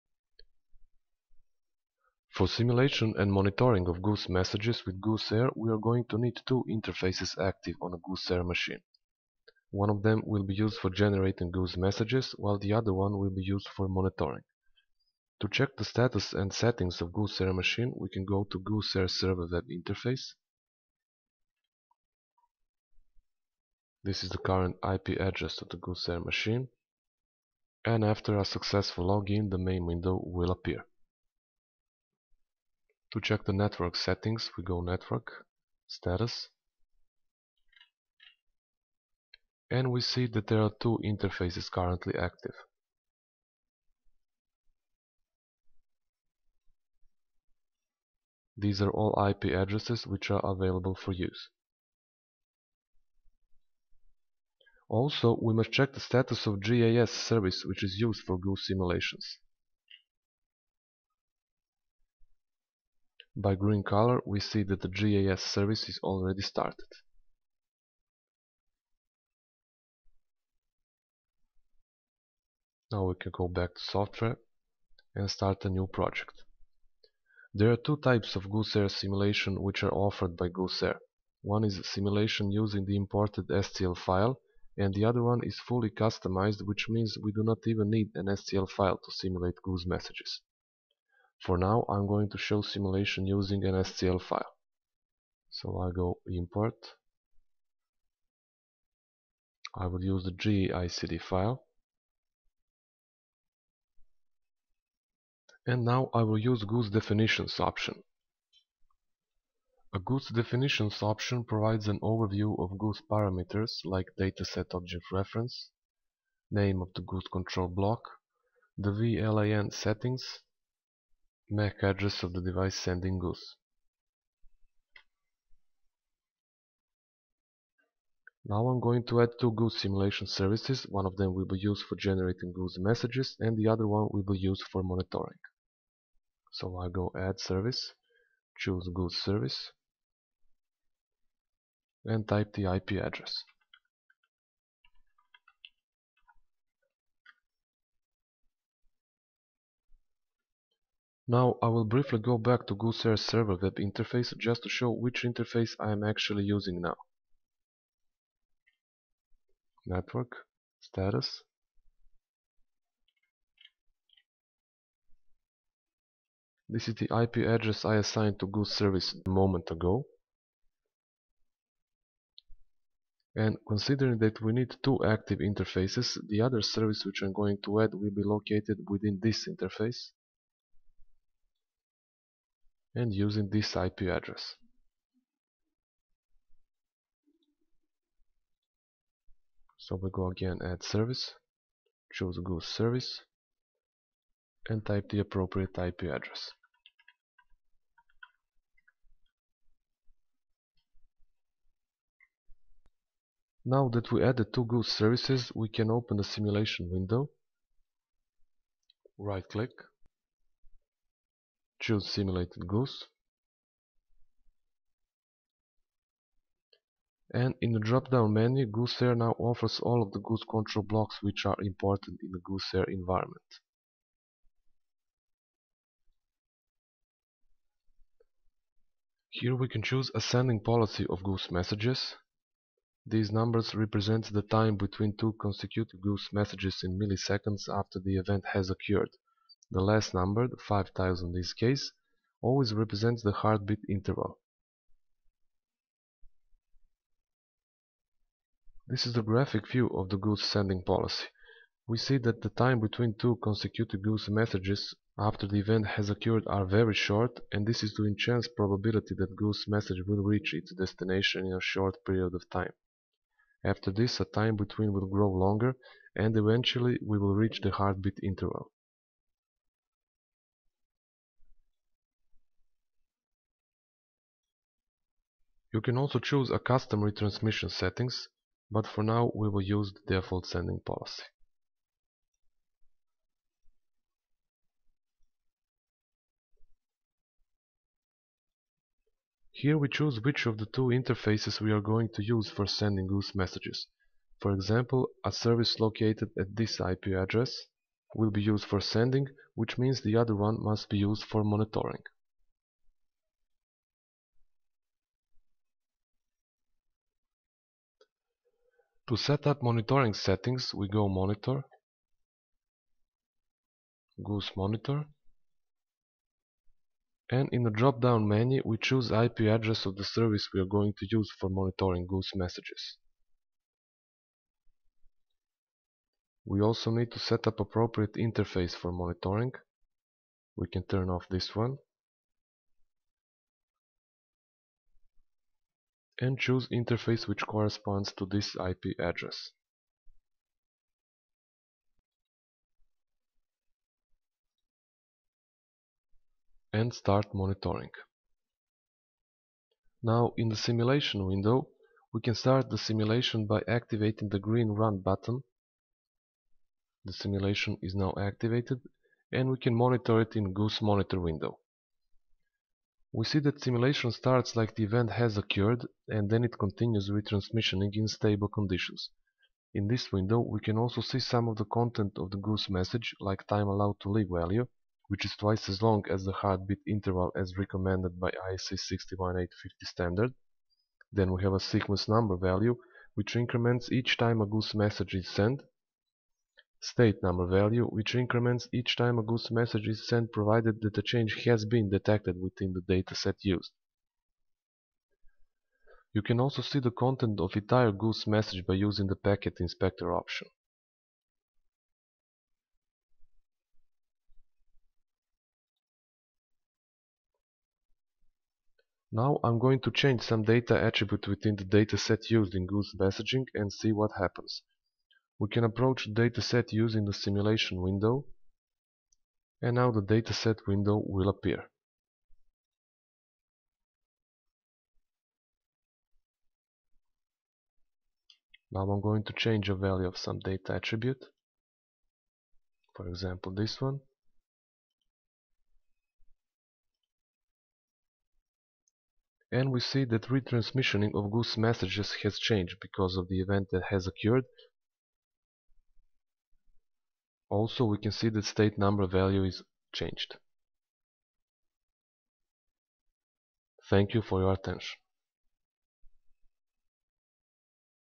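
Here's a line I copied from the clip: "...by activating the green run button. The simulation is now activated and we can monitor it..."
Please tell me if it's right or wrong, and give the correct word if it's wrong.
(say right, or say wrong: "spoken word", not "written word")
right.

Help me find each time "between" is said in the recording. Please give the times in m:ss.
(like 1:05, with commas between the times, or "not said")
3:54, 4:12, 4:24.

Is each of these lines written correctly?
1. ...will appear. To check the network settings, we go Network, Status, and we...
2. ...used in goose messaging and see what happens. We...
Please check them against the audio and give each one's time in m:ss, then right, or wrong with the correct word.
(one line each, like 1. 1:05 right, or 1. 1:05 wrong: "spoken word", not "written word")
1. 0:30 right
2. 6:52 right.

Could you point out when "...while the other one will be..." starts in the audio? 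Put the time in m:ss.
0:12.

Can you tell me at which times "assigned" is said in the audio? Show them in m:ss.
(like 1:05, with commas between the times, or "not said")
2:48.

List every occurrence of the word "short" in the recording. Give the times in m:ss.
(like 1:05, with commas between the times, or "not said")
4:16, 4:21.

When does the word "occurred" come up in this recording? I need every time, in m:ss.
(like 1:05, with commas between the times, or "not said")
3:58, 4:16, 6:05, 7:24.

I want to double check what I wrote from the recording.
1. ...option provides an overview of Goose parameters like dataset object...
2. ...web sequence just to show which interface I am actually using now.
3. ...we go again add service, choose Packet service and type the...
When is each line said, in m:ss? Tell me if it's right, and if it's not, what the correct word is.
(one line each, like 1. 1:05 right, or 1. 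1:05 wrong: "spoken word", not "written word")
1. 1:51 right
2. 2:33 wrong: "interface", not "sequence"
3. 3:10 wrong: "Goose", not "Packet".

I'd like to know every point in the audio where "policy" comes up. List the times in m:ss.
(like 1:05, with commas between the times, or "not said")
3:50, 4:10, 4:40.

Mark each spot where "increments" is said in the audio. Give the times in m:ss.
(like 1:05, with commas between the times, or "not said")
6:23, 6:28.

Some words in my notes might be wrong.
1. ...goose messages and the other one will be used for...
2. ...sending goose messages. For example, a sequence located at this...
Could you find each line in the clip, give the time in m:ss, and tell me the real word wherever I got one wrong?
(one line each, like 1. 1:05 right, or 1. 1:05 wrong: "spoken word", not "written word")
1. 2:12 right
2. 4:52 wrong: "service", not "sequence".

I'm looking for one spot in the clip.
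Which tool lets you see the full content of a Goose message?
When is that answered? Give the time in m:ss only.
6:39.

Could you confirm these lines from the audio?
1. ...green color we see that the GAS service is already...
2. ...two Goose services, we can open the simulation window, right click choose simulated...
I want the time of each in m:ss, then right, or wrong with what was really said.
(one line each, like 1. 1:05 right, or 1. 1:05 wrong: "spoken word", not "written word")
1. 1:03 right
2. 3:24 right.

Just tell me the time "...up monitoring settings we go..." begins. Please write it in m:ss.
5:09.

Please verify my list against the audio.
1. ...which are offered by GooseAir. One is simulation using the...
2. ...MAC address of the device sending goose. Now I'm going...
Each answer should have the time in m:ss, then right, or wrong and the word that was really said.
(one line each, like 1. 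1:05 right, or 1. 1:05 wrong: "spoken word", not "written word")
1. 1:19 right
2. 2:01 right.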